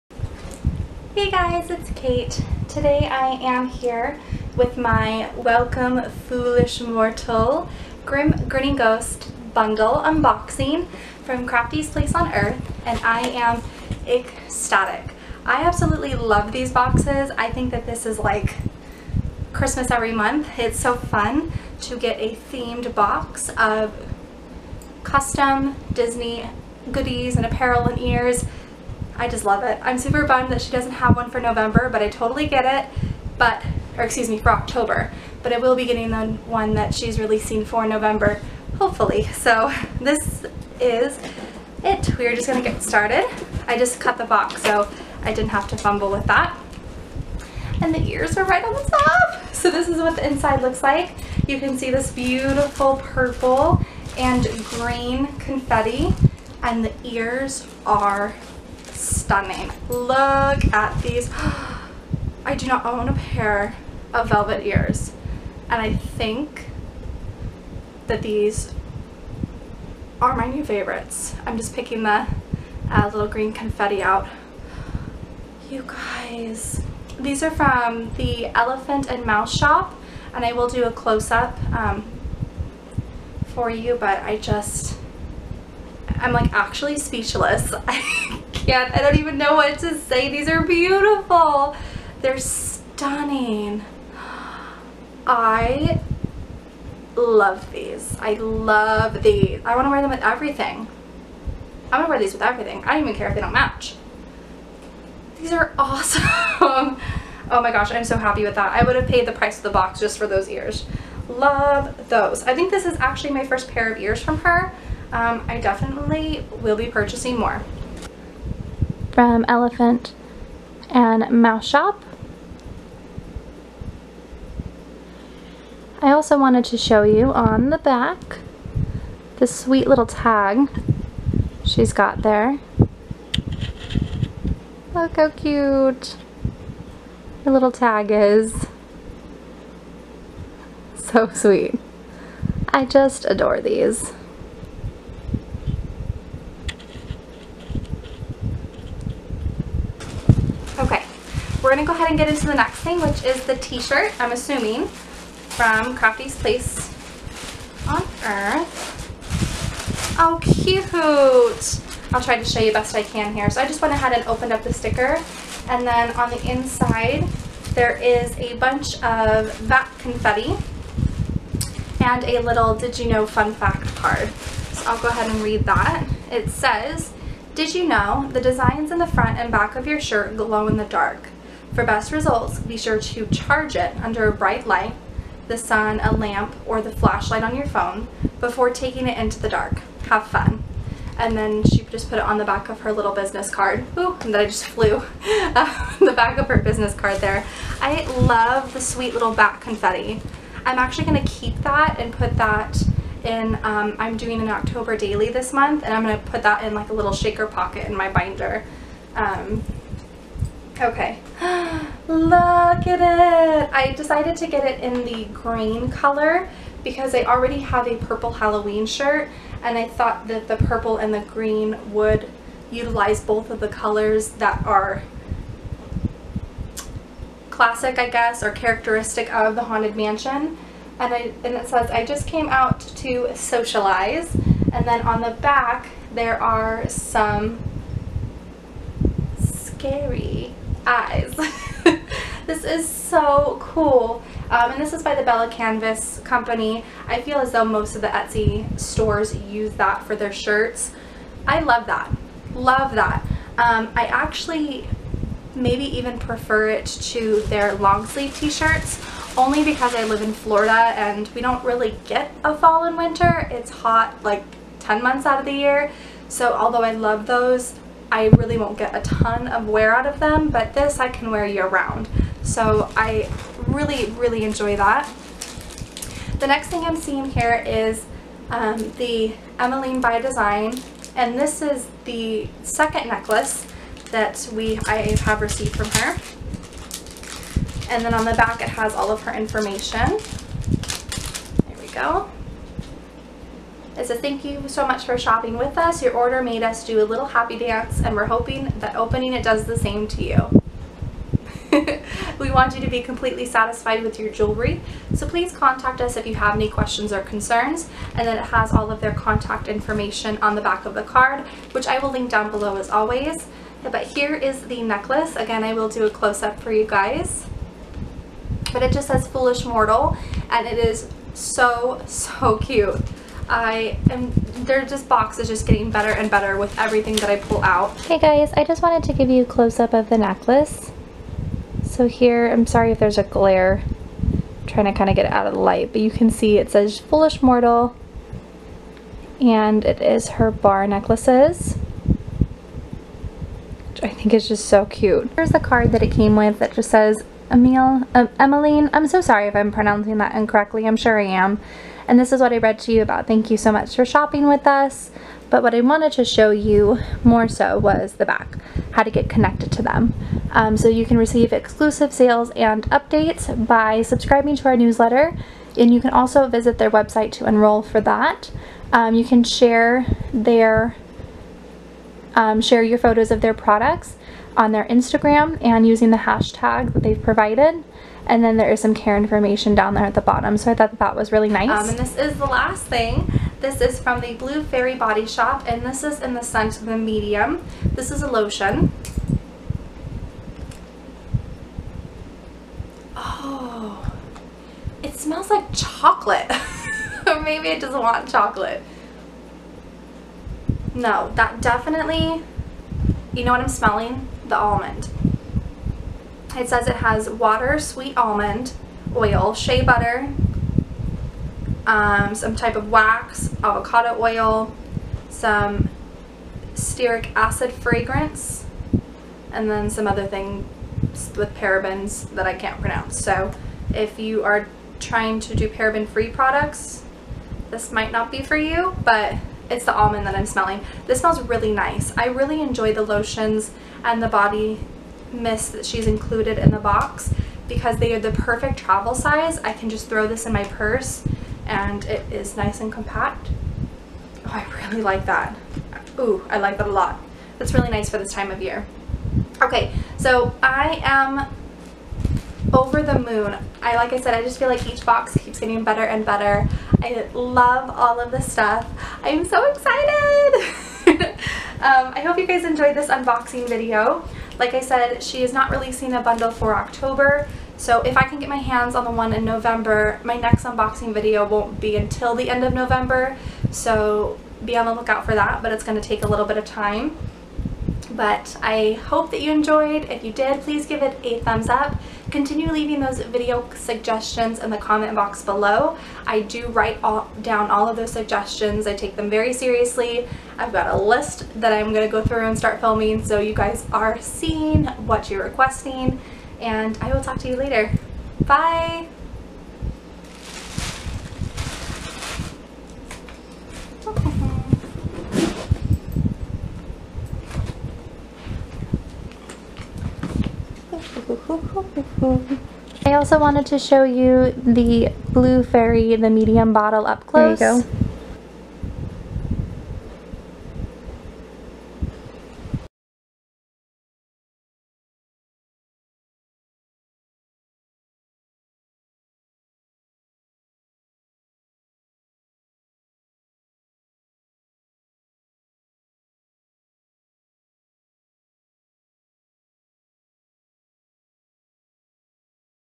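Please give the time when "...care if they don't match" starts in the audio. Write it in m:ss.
1:43.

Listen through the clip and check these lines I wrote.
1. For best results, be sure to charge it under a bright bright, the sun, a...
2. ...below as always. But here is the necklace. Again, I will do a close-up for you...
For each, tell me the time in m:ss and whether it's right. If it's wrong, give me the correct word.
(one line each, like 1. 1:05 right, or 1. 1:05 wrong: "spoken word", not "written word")
1. 3:01 wrong: "light", not "bright"
2. 5:12 right.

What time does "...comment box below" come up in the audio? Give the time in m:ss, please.
8:04.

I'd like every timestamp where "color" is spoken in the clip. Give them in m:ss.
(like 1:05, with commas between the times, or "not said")
3:35, 3:43.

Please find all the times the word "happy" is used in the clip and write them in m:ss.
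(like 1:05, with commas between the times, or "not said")
1:48, 4:57.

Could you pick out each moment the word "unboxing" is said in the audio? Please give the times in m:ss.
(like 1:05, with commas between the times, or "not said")
0:09, 7:43, 7:50.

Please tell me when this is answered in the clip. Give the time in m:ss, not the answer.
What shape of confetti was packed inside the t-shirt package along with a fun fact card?
3:19.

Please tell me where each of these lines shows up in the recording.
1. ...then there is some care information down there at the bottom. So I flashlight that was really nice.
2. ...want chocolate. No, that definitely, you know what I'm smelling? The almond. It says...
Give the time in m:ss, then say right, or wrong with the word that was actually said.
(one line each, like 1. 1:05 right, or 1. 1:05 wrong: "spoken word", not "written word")
1. 6:18 wrong: "thought", not "flashlight"
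2. 6:37 right.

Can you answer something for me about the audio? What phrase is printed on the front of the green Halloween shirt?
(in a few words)
I just came out to socialize.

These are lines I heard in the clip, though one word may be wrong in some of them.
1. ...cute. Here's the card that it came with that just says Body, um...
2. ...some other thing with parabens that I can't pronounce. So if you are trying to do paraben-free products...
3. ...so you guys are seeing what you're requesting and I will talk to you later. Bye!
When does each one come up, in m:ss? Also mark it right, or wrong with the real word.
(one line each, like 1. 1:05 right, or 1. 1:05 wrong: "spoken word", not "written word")
1. 5:44 wrong: "Emil", not "Body"
2. 6:59 right
3. 8:13 right.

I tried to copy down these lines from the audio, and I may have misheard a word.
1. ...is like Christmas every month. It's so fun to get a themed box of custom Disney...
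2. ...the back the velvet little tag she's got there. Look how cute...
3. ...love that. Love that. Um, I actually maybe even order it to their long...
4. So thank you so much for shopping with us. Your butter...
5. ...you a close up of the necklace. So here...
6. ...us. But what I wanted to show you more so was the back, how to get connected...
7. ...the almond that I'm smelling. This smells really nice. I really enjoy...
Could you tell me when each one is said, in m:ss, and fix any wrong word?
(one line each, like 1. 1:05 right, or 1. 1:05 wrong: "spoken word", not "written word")
1. 0:18 right
2. 2:07 wrong: "sweet", not "velvet"
3. 4:11 wrong: "prefer", not "order"
4. 4:54 wrong: "order", not "butter"
5. 5:29 right
6. 5:54 right
7. 7:09 right.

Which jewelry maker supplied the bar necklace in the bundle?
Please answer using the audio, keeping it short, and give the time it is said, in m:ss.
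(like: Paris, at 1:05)
Emmeline by Design, at 4:39.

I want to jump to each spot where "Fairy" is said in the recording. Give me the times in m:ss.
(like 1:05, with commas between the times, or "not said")
6:24, 8:35.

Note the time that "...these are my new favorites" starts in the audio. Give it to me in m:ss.
1:08.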